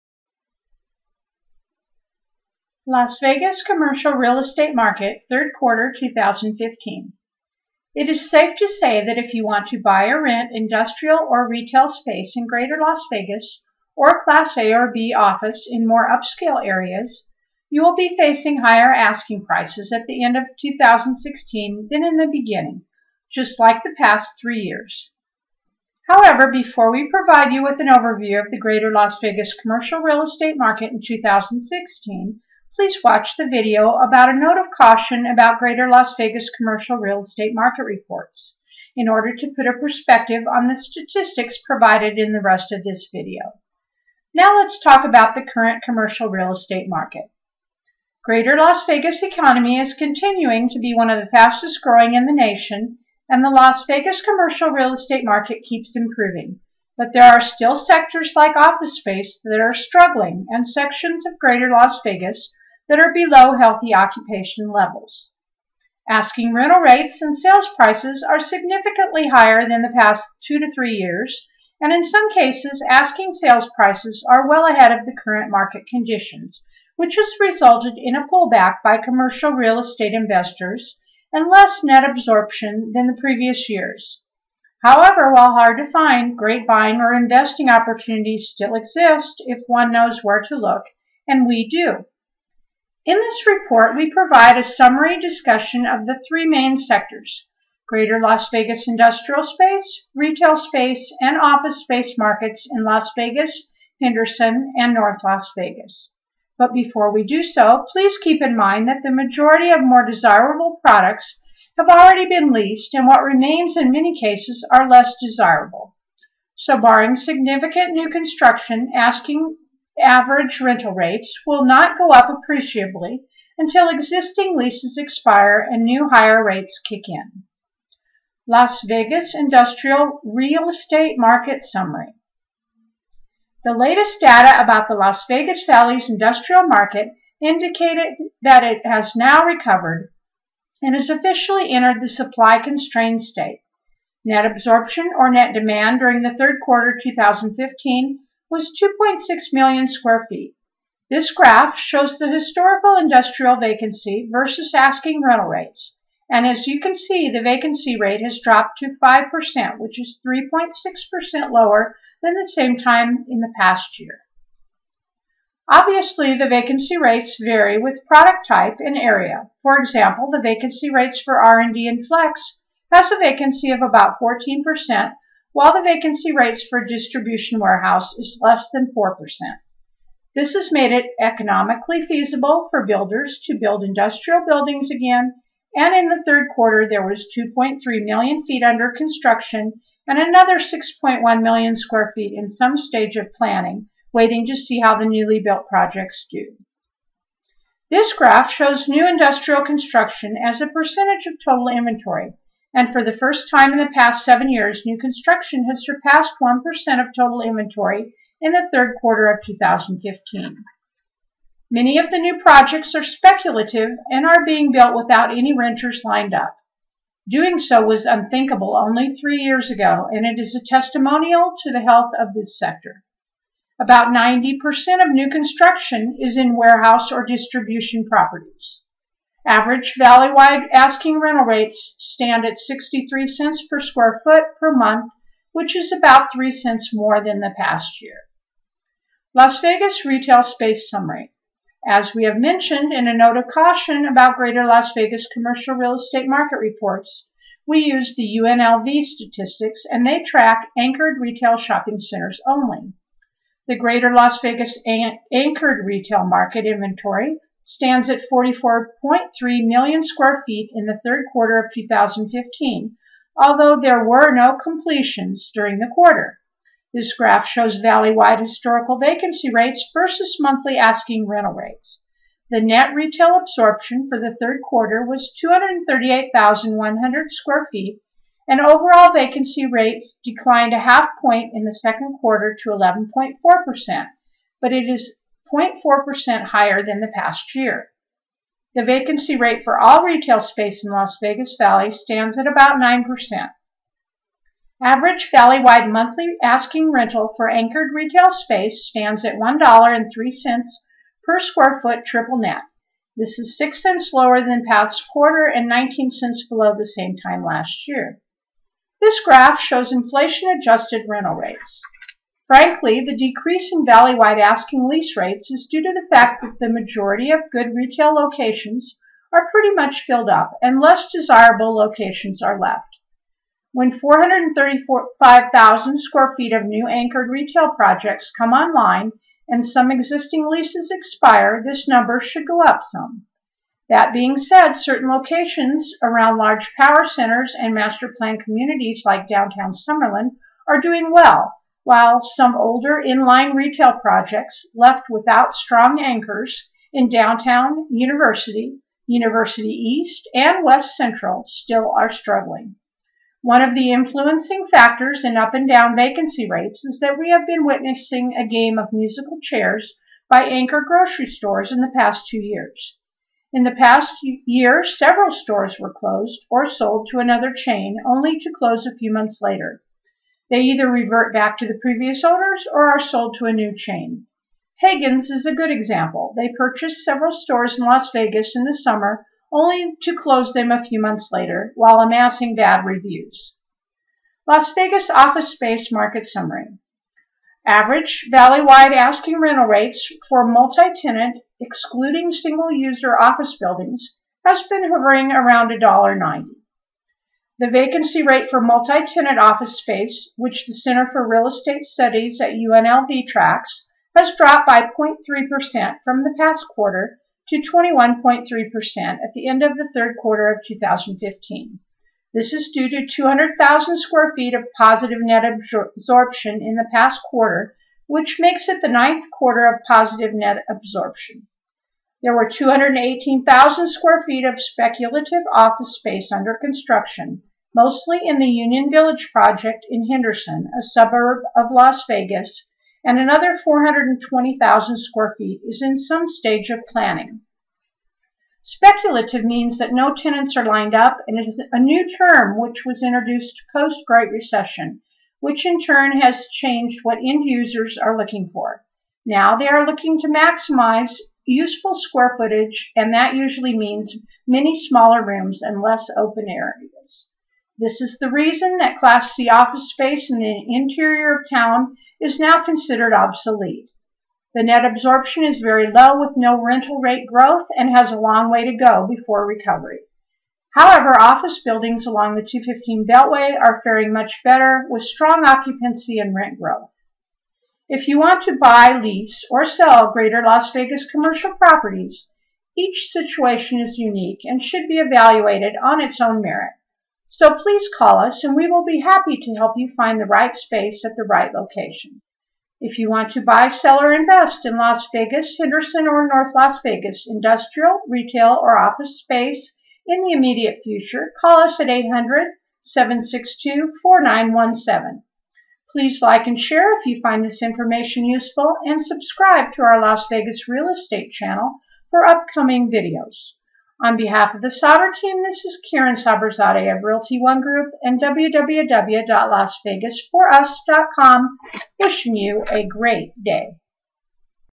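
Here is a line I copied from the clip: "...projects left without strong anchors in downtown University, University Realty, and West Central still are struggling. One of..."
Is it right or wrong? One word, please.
wrong.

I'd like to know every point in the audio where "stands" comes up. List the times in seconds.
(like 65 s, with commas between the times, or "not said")
231 s, 257 s, 291 s, 298 s.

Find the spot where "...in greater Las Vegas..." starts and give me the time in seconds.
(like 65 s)
12 s.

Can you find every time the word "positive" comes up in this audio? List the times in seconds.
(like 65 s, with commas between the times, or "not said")
414 s, 419 s.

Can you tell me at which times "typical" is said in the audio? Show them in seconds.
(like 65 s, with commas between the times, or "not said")
not said.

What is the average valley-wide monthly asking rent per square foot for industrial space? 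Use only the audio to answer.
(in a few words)
63 cents.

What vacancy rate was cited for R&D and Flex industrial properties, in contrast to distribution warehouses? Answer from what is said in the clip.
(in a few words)
14%.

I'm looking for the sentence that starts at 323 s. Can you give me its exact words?
When 435,000 square feet of new anchored retail projects come online and some existing leases expire, this number should go up some.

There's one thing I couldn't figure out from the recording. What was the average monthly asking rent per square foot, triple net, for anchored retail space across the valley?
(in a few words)
$1.03.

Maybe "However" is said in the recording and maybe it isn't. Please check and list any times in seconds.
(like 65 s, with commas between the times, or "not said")
26 s, 84 s, 470 s.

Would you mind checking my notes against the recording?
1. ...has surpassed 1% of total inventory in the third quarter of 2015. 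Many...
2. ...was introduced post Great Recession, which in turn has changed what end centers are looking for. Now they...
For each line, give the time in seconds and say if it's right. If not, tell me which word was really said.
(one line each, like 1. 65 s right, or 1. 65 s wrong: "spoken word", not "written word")
1. 205 s right
2. 442 s wrong: "users", not "centers".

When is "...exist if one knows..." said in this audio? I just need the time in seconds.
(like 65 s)
88 s.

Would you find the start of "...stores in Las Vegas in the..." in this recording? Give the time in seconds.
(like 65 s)
377 s.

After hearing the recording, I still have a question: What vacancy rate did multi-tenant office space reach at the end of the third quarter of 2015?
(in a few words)
21.3%.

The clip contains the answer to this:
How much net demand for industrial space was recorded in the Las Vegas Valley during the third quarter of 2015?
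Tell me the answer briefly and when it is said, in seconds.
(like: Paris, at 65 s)
2.6 million square feet, at 148 s.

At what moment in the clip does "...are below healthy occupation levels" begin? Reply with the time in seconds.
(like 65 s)
62 s.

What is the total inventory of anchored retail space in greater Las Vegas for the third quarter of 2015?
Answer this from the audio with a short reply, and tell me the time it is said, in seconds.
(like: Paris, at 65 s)
44.3 million square feet, at 258 s.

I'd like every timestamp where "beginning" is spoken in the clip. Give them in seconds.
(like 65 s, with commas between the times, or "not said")
22 s.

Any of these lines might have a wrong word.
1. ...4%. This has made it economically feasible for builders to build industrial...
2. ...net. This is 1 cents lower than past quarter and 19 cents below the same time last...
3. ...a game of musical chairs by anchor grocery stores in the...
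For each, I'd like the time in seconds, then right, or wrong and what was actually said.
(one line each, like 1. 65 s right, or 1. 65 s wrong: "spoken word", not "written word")
1. 178 s right
2. 302 s wrong: "6", not "1"
3. 358 s right.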